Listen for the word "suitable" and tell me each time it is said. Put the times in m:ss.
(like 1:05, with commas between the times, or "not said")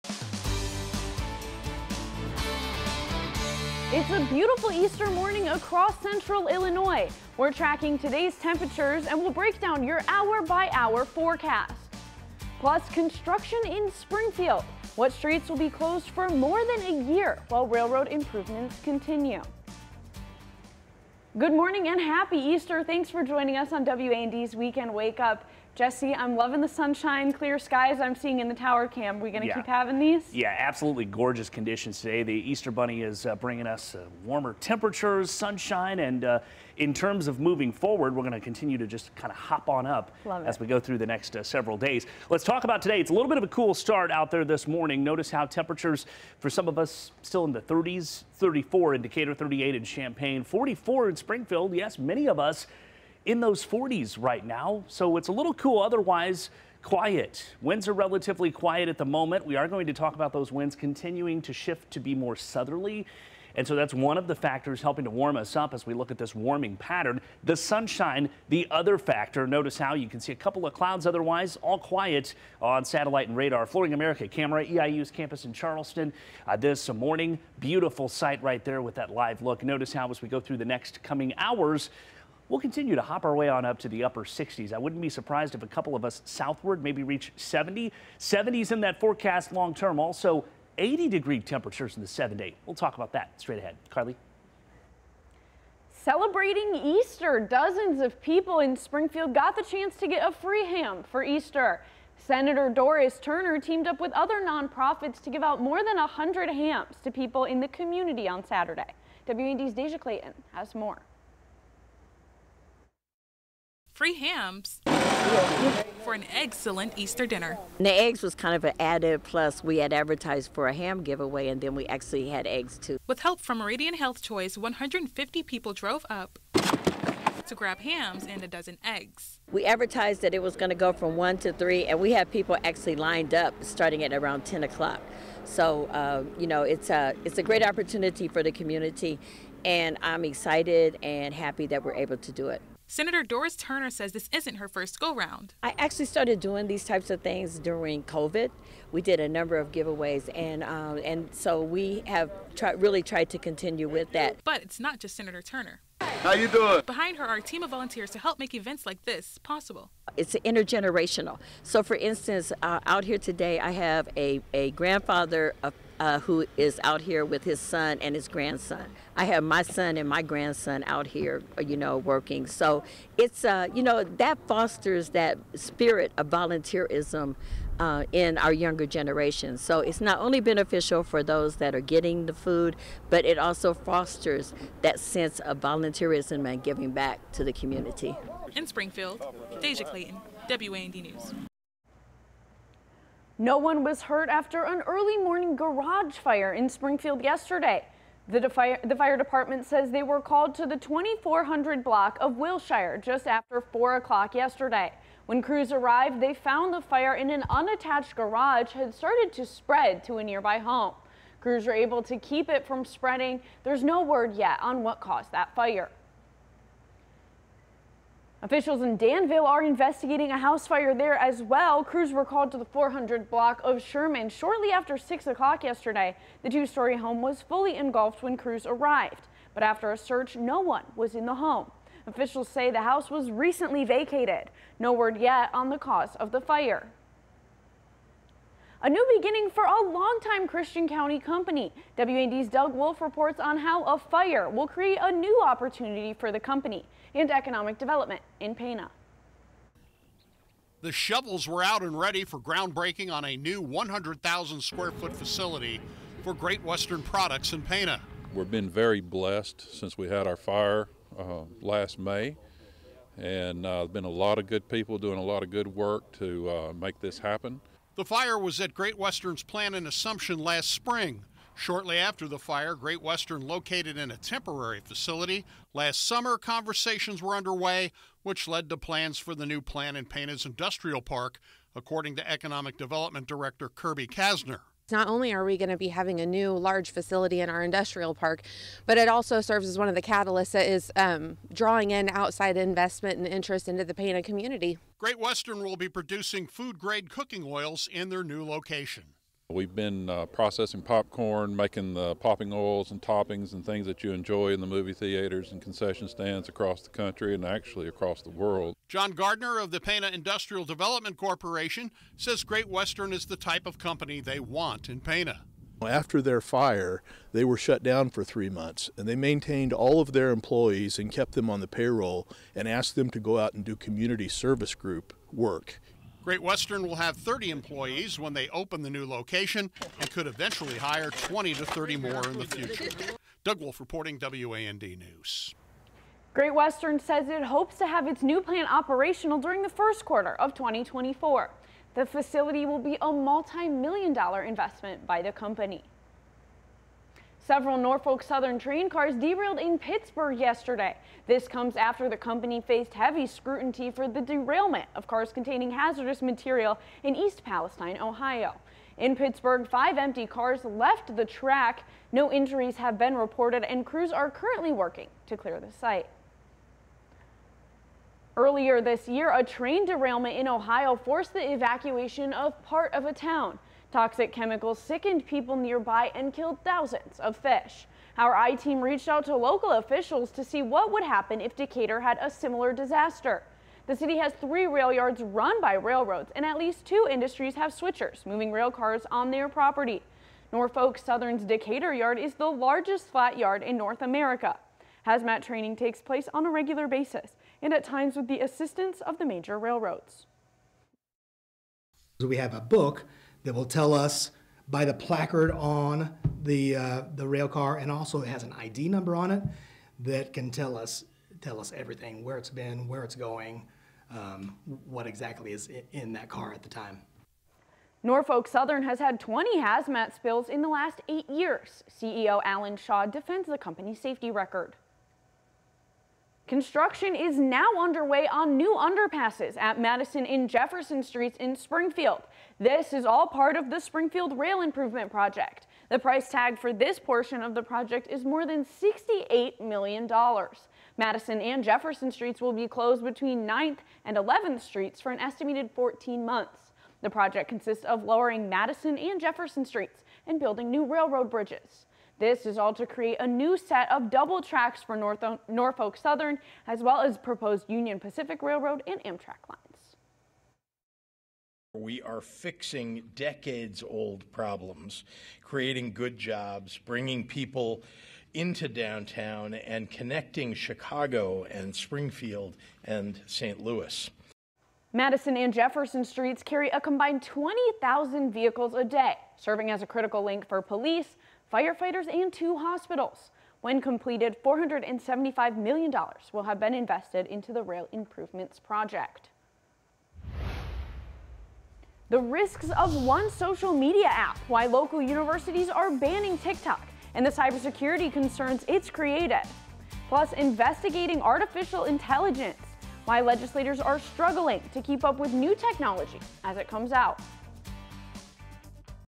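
not said.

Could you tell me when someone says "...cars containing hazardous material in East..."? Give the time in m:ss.
5:55.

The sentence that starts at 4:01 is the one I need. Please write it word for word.
WAND's Doug Wolf reports on how a fire will create a new opportunity for the company and economic development in Pana.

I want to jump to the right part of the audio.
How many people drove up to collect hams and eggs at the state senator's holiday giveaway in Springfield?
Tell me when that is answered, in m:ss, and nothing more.
2:04.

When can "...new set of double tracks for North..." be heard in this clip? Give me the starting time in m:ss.
7:33.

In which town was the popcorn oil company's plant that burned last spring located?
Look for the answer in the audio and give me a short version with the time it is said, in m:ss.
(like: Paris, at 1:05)
Assumption, at 4:29.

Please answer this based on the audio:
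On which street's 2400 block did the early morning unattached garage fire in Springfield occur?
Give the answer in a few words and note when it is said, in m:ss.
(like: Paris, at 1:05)
Wilshire, at 3:22.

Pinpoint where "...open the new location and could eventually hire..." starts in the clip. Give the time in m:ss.
5:28.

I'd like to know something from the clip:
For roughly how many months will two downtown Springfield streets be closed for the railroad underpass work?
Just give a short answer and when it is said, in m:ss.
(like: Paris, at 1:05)
14, at 7:25.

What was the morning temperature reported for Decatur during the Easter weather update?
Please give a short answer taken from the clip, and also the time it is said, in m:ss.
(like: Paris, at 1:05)
34, at 0:48.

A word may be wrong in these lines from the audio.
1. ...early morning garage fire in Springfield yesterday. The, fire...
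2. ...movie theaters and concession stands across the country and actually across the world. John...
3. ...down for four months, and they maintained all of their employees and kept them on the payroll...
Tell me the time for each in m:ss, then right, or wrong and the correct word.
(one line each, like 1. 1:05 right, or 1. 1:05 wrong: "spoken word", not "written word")
1. 3:14 right
2. 5:04 right
3. 5:17 wrong: "three", not "four".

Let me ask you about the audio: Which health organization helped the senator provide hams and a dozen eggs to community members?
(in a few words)
Meridian Health Choice.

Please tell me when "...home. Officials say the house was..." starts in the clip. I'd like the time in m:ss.
3:51.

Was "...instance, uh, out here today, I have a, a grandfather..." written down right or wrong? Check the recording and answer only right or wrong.
right.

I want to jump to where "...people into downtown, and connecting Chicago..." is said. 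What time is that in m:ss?
7:47.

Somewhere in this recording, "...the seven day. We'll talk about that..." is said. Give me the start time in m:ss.
1:32.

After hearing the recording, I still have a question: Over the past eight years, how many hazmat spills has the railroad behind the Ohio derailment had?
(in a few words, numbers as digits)
20.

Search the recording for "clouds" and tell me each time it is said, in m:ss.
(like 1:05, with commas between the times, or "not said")
1:10.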